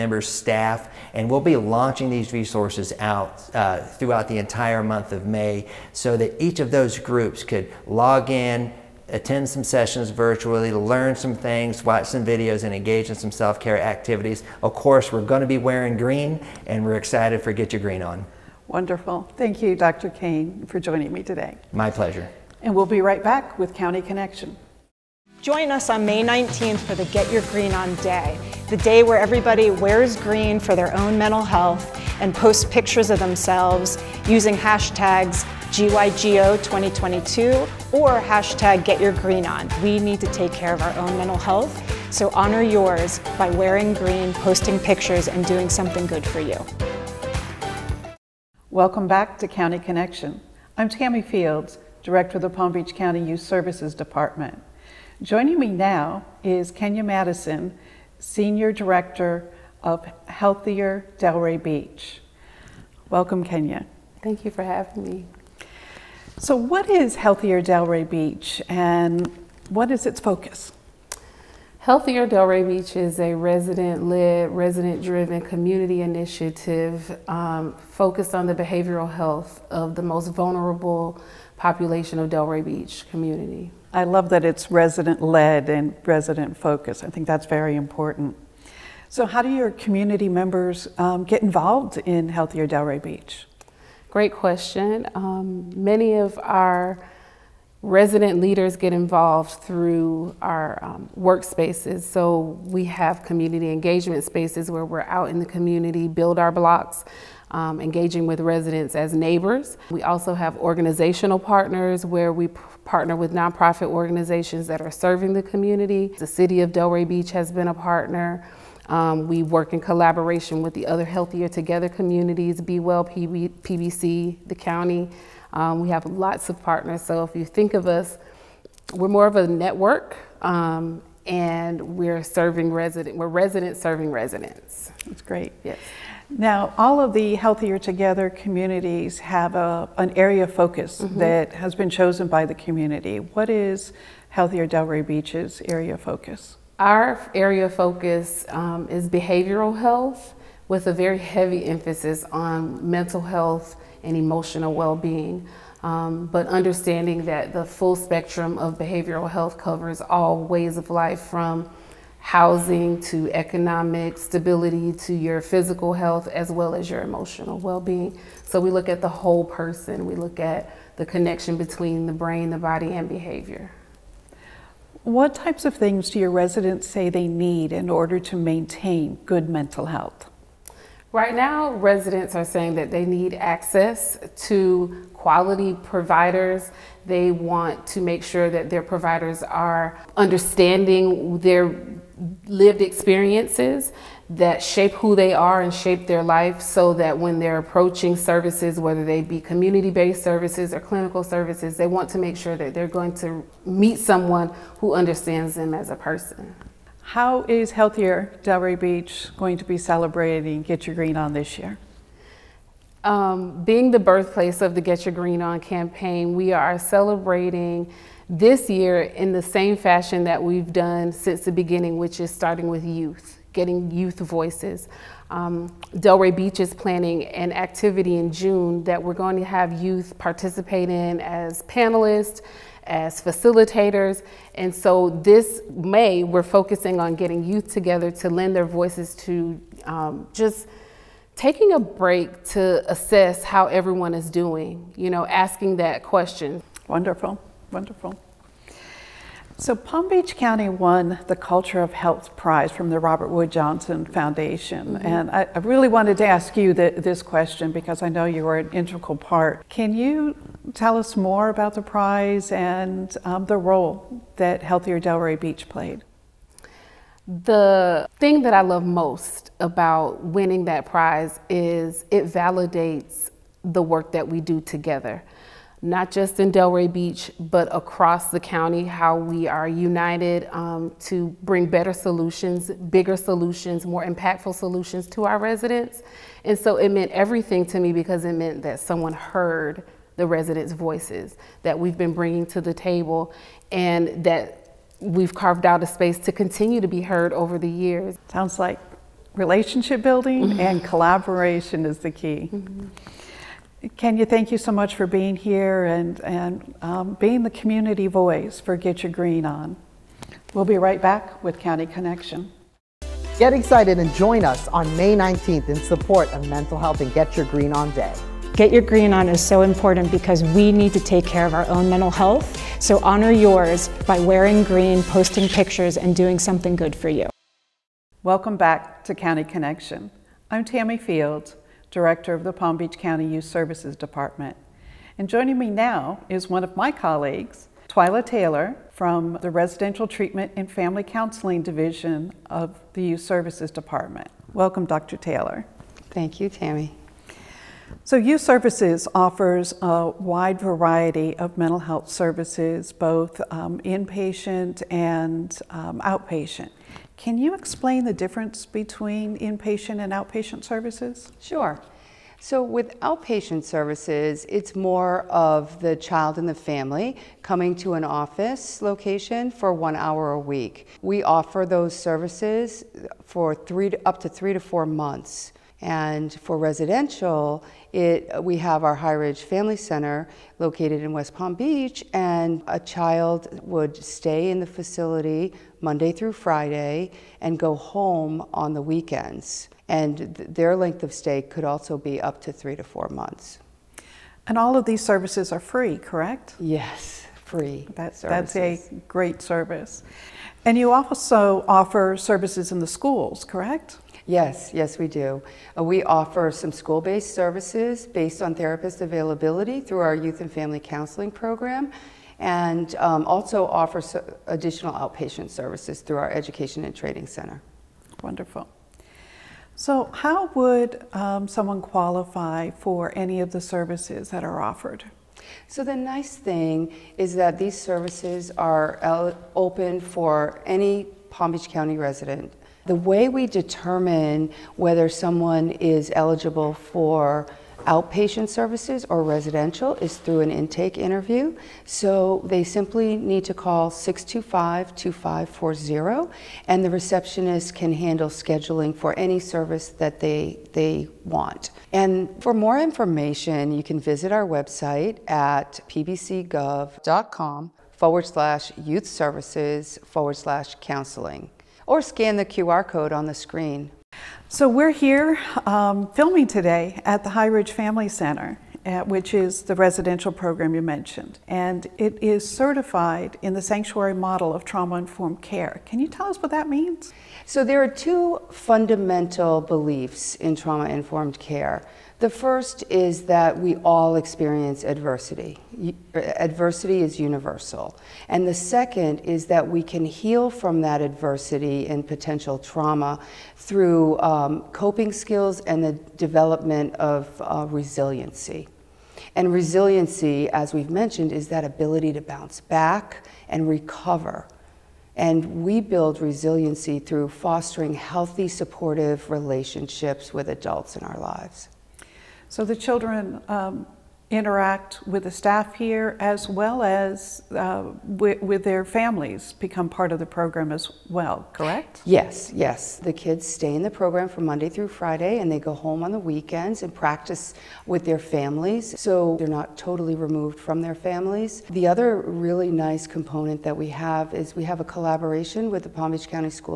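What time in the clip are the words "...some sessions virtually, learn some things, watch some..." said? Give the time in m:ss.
0:09.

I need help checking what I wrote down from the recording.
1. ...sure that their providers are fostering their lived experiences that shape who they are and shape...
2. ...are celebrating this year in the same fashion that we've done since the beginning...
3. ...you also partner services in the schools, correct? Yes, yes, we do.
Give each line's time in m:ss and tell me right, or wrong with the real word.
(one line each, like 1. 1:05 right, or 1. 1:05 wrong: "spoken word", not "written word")
1. 3:08 wrong: "understanding", not "fostering"
2. 3:36 right
3. 6:40 wrong: "offer", not "partner".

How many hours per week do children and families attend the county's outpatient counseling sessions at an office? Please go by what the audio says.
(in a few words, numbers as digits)
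1.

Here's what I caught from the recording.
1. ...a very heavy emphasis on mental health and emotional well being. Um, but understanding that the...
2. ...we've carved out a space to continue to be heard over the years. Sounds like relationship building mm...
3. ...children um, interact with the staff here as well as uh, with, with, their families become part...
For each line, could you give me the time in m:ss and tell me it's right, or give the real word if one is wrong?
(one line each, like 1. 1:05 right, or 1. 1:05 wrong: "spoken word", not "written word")
1. 2:30 right
2. 4:54 right
3. 8:32 right.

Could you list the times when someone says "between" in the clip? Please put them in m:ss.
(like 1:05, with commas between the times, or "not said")
2:51, 5:58.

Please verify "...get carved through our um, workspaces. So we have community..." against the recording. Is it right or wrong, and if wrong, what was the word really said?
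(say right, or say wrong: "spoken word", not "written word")
wrong: "involved", not "carved".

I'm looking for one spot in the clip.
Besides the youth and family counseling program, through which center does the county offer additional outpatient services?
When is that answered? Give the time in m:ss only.
6:56.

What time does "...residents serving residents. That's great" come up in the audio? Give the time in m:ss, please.
2:13.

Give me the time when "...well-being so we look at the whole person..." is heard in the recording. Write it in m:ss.
2:47.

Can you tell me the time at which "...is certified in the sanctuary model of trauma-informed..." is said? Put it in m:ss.
7:52.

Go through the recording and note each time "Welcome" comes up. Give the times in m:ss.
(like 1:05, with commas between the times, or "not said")
0:48, 1:03, 5:28, 5:44.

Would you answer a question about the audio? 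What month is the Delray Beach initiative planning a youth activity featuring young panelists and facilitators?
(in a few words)
June.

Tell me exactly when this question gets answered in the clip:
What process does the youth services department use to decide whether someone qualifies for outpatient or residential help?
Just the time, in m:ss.
7:20.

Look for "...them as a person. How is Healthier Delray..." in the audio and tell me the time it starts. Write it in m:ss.
3:25.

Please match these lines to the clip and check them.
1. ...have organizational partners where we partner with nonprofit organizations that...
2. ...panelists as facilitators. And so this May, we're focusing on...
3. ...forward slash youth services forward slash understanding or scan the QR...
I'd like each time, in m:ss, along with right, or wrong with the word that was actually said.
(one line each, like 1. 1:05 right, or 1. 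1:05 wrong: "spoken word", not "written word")
1. 1:50 right
2. 3:51 right
3. 7:37 wrong: "counseling", not "understanding".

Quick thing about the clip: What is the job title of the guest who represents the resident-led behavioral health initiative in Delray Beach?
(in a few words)
Senior Director.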